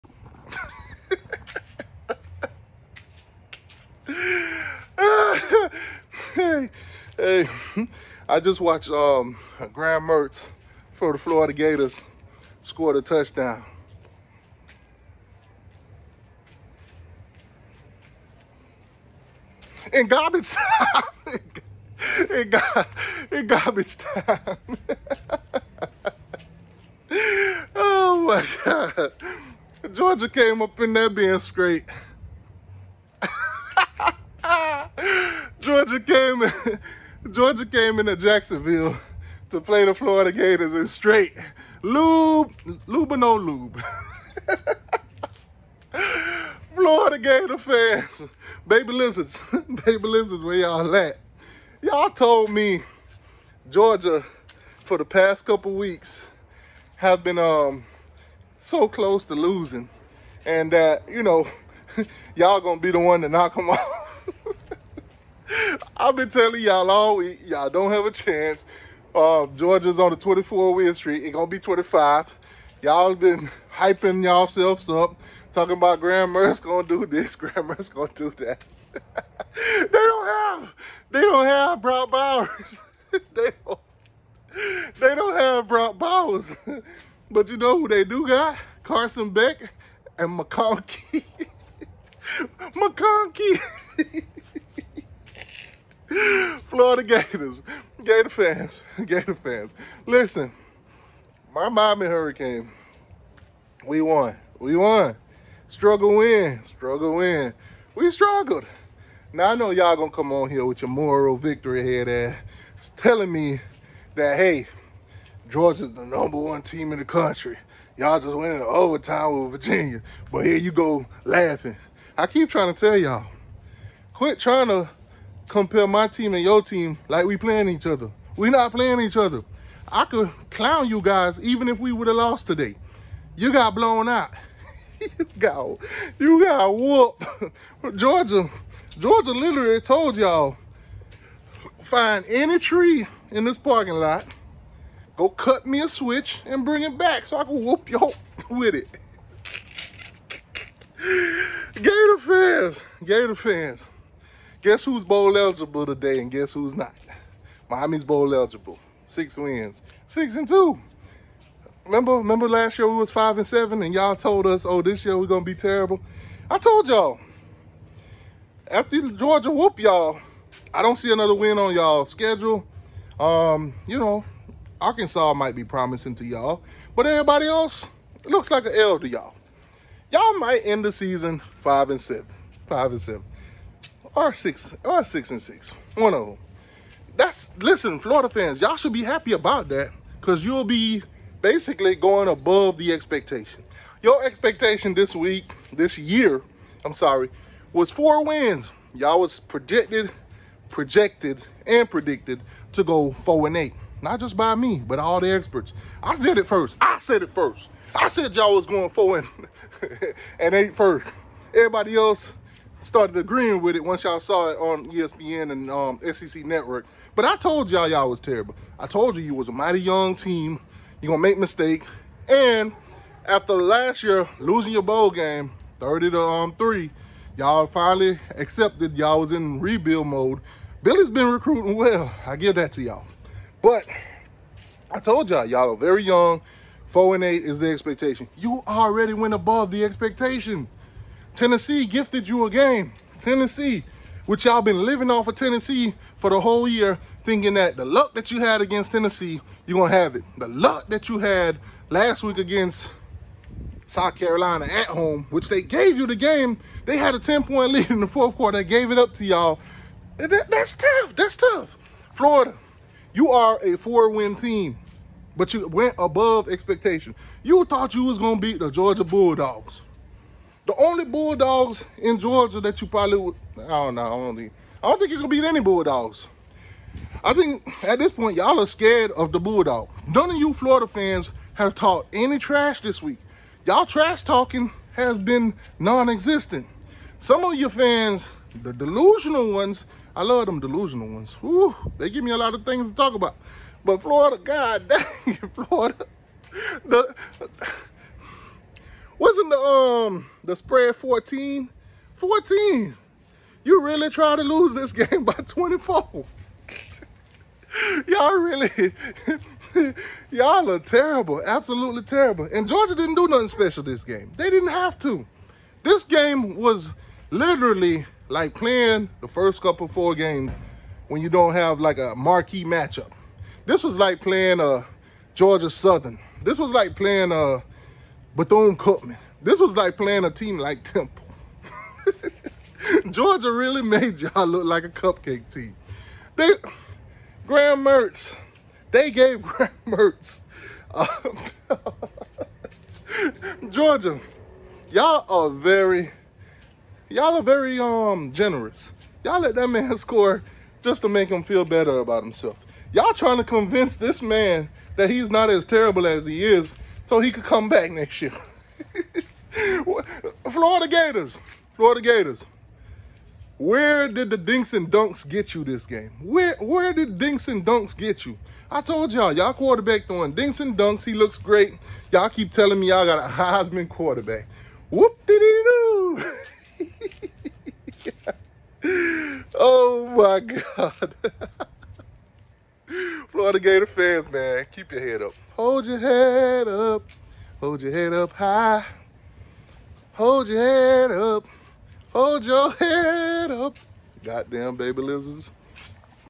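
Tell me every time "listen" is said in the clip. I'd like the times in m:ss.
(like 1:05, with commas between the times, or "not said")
1:40, 3:07.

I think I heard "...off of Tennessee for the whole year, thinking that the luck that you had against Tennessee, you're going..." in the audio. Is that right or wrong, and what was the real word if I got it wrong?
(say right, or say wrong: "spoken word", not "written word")
right.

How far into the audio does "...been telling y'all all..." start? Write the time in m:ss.
1:06.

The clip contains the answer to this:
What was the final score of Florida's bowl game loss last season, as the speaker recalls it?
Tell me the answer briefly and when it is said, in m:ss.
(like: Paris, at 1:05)
30 to 3, at 3:45.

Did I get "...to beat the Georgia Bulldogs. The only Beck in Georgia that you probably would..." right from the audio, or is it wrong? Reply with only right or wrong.
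wrong.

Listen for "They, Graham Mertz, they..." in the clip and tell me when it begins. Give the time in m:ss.
5:36.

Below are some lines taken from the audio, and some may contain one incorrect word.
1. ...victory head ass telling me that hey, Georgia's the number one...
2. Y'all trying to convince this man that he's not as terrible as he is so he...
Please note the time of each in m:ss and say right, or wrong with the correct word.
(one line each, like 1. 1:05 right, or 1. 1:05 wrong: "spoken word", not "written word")
1. 1:51 right
2. 5:52 right.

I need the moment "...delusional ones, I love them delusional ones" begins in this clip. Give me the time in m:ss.
4:48.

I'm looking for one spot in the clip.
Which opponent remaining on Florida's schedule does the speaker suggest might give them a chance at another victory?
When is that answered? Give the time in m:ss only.
2:54.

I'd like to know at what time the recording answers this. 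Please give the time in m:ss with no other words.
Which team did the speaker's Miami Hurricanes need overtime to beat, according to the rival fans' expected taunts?
1:59.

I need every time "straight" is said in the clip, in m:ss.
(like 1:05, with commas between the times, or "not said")
0:31, 0:40.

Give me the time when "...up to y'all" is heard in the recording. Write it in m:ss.
4:18.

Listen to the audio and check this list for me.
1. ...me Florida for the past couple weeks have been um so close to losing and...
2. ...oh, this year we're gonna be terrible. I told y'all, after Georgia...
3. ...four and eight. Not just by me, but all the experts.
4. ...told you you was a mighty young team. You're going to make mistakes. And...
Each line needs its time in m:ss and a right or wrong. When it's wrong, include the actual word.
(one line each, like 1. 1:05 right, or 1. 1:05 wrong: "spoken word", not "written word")
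1. 0:52 wrong: "Georgia", not "Florida"
2. 2:44 right
3. 3:23 right
4. 3:38 right.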